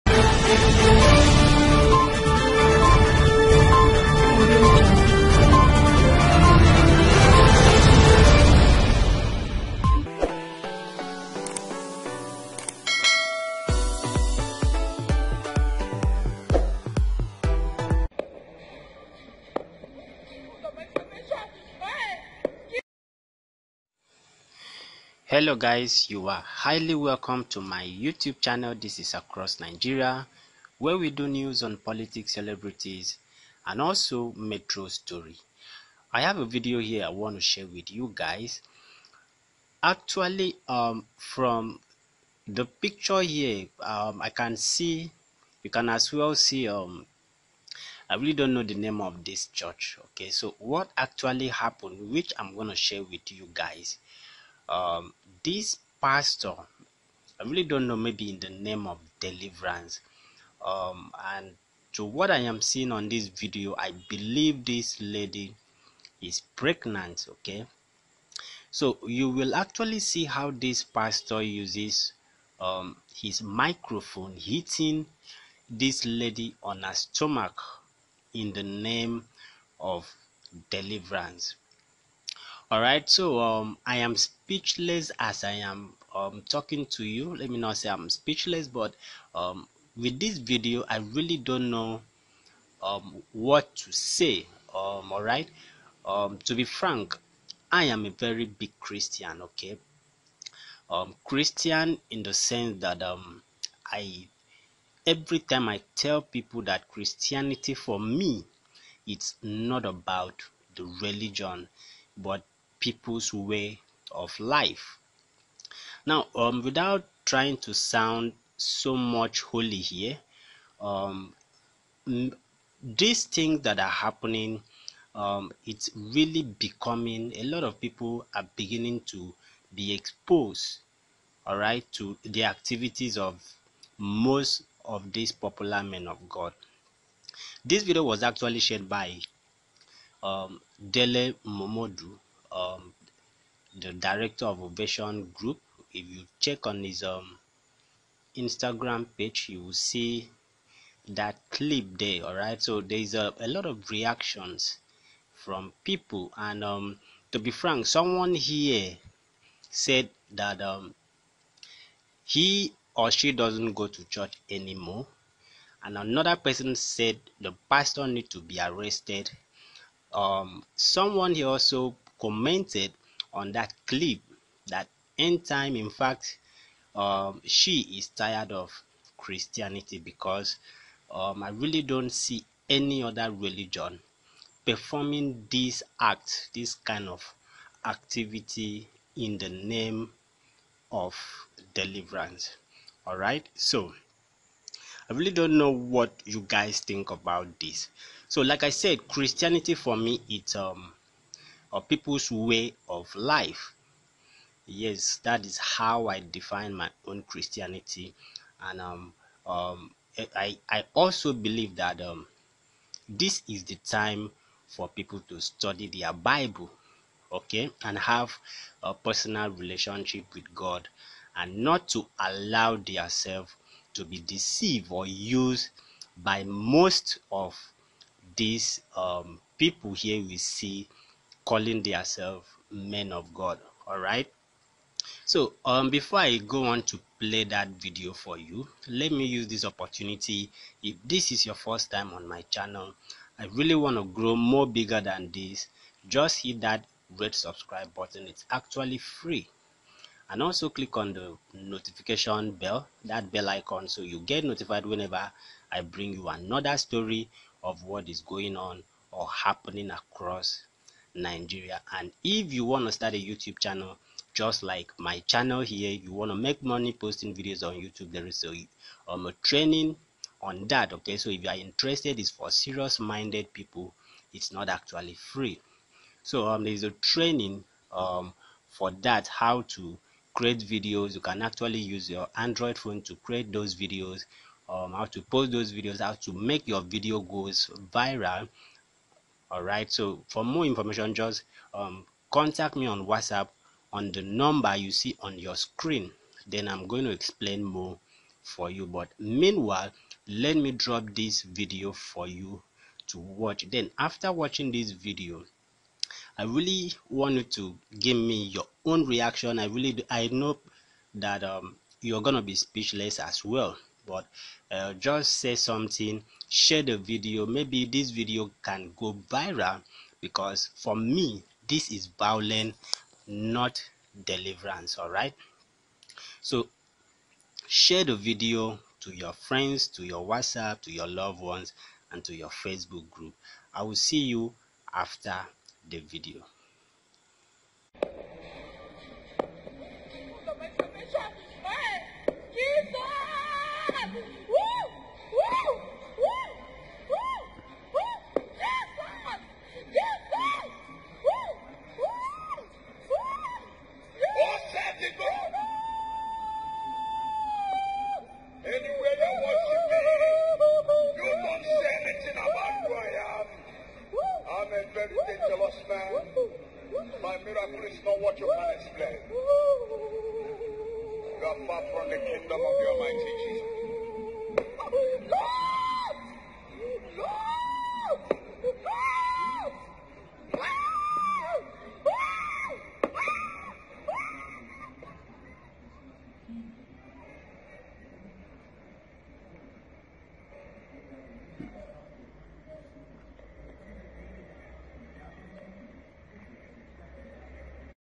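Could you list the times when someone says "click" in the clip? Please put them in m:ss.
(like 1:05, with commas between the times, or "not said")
4:10.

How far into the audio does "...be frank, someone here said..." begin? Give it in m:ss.
2:37.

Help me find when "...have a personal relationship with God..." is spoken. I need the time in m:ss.
3:37.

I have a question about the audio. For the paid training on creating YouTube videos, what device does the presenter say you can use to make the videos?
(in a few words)
Android phone.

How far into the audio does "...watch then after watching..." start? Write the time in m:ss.
5:03.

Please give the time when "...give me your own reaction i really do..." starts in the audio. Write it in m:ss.
5:07.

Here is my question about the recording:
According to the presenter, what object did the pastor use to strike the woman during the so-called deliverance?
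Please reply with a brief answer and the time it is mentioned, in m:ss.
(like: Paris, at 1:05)
Microphone, at 1:13.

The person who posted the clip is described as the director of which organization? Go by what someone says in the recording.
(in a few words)
Ovation Group.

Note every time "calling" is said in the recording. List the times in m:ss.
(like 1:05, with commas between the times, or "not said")
3:51.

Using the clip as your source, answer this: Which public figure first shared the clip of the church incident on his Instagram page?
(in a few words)
Dele Momodu.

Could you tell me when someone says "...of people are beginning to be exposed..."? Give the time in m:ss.
2:07.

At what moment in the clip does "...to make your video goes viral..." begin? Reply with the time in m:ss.
4:46.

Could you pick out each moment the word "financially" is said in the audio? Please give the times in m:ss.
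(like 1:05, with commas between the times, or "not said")
not said.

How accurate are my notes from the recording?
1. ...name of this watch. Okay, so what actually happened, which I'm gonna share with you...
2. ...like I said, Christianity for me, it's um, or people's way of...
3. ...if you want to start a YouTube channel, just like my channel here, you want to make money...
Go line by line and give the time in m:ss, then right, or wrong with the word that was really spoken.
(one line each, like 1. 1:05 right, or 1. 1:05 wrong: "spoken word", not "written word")
1. 0:48 wrong: "church", not "watch"
2. 3:18 right
3. 4:22 right.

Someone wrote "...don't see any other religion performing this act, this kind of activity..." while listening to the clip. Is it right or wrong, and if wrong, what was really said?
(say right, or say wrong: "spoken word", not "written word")
right.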